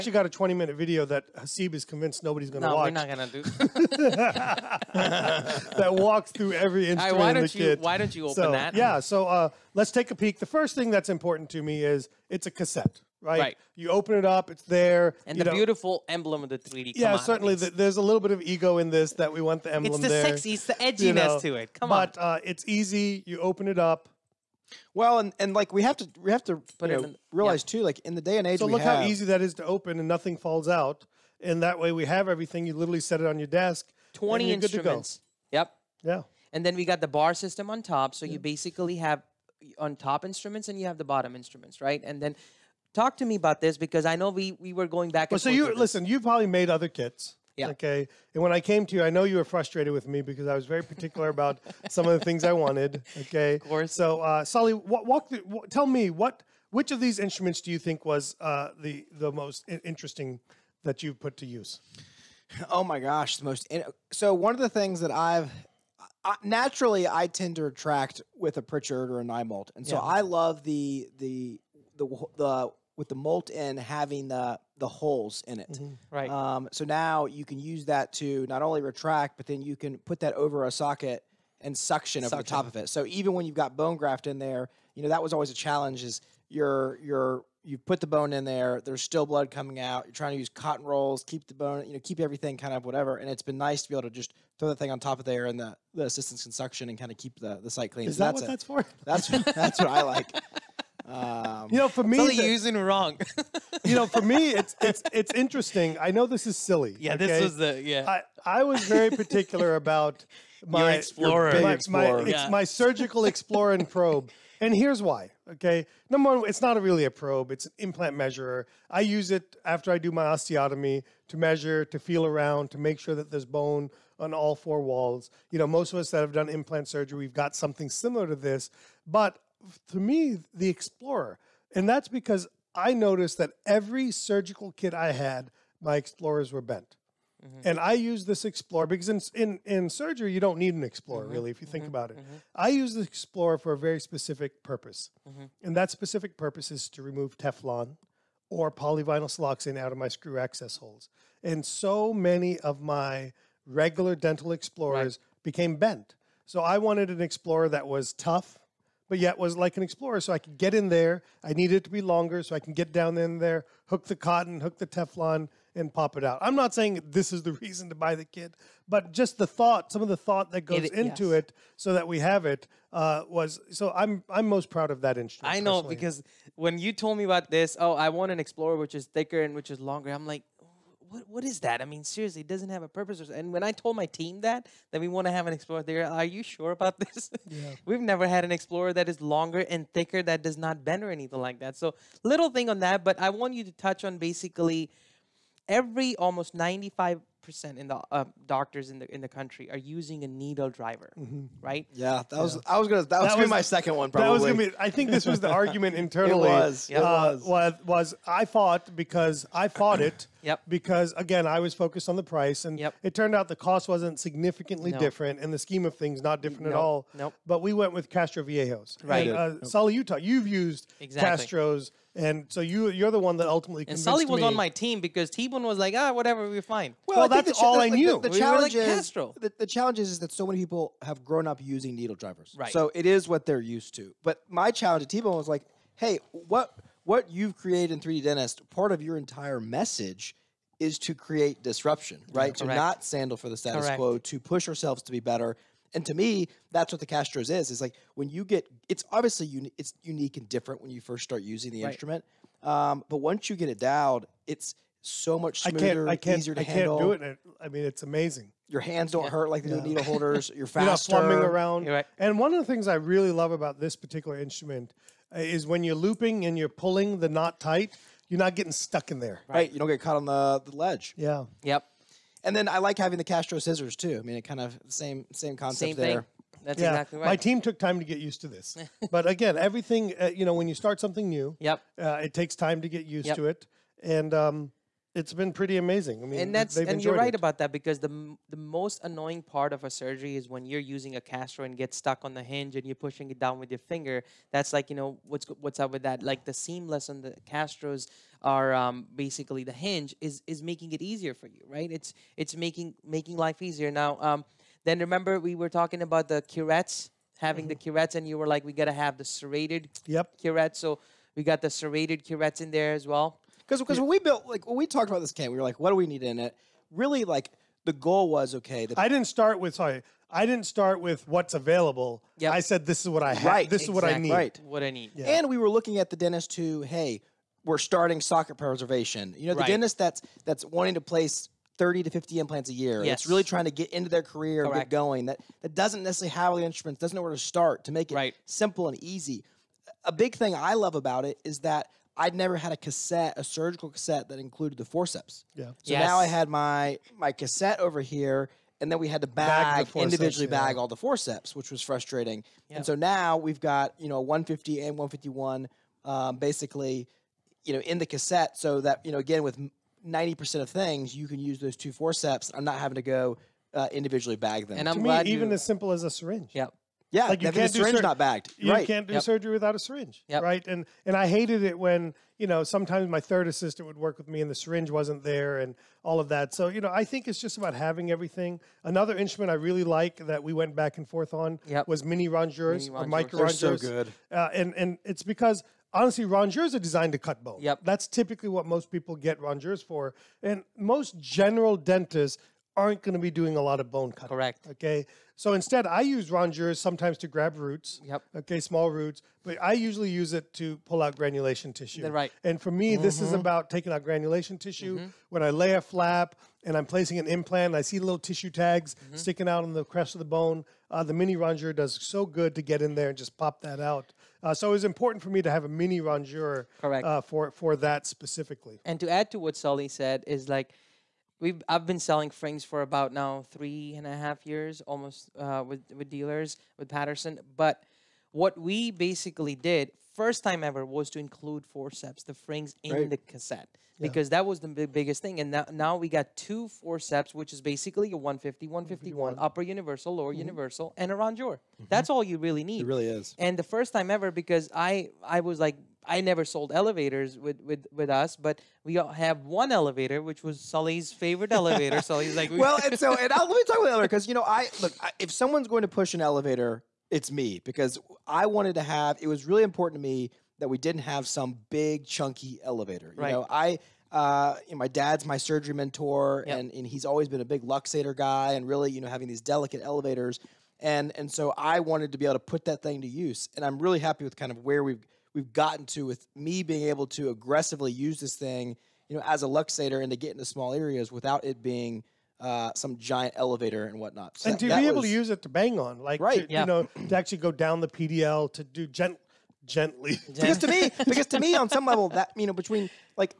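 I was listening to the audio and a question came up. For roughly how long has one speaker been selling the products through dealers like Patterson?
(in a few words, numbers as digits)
3 and a half years.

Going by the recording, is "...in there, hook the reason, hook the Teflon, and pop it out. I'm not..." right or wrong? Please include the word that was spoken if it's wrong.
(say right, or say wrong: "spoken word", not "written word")
wrong: "cotton", not "reason".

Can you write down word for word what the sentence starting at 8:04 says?
So and that, to be was, able to use it to bang on, like right, to, yeah.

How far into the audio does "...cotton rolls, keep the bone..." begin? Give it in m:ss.
1:30.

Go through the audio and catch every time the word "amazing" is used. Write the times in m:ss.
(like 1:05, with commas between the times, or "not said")
4:18, 4:45.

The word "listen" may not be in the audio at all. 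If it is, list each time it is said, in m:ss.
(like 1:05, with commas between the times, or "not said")
0:45.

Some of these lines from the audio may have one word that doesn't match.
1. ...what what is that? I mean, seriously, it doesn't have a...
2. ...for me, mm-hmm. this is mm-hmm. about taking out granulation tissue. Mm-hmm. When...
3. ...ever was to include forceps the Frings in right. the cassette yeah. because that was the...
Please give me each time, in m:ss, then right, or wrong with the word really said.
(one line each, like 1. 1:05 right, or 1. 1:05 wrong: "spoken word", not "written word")
1. 3:01 right
2. 6:42 right
3. 7:10 right.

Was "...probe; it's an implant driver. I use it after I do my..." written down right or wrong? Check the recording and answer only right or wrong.
wrong.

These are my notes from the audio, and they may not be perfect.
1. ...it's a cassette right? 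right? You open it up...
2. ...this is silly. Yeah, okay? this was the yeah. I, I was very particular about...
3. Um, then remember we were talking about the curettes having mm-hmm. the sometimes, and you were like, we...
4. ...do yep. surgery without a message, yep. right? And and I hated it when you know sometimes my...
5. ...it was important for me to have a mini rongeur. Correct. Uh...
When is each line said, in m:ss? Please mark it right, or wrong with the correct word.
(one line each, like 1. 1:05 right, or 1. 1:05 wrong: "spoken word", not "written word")
1. 0:12 right
2. 1:46 right
3. 5:04 wrong: "curettes", not "sometimes"
4. 6:09 wrong: "syringe", not "message"
5. 6:54 right.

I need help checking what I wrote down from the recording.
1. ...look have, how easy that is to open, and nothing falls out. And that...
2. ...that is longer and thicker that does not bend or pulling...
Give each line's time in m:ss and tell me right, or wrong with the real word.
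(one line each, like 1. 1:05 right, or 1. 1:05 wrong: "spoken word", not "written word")
1. 0:28 right
2. 3:08 wrong: "anything", not "pulling".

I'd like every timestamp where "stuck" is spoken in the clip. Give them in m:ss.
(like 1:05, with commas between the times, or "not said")
4:28, 4:51.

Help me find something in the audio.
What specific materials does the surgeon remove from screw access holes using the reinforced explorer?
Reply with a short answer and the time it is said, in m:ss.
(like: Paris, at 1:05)
Teflon or polyvinyl siloxane, at 2:27.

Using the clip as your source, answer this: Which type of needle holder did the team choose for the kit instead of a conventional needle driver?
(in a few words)
Castroviejos.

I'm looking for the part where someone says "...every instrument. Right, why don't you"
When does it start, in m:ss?
0:06.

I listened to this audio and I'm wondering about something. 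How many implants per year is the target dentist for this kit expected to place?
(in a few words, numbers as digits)
30 to 50.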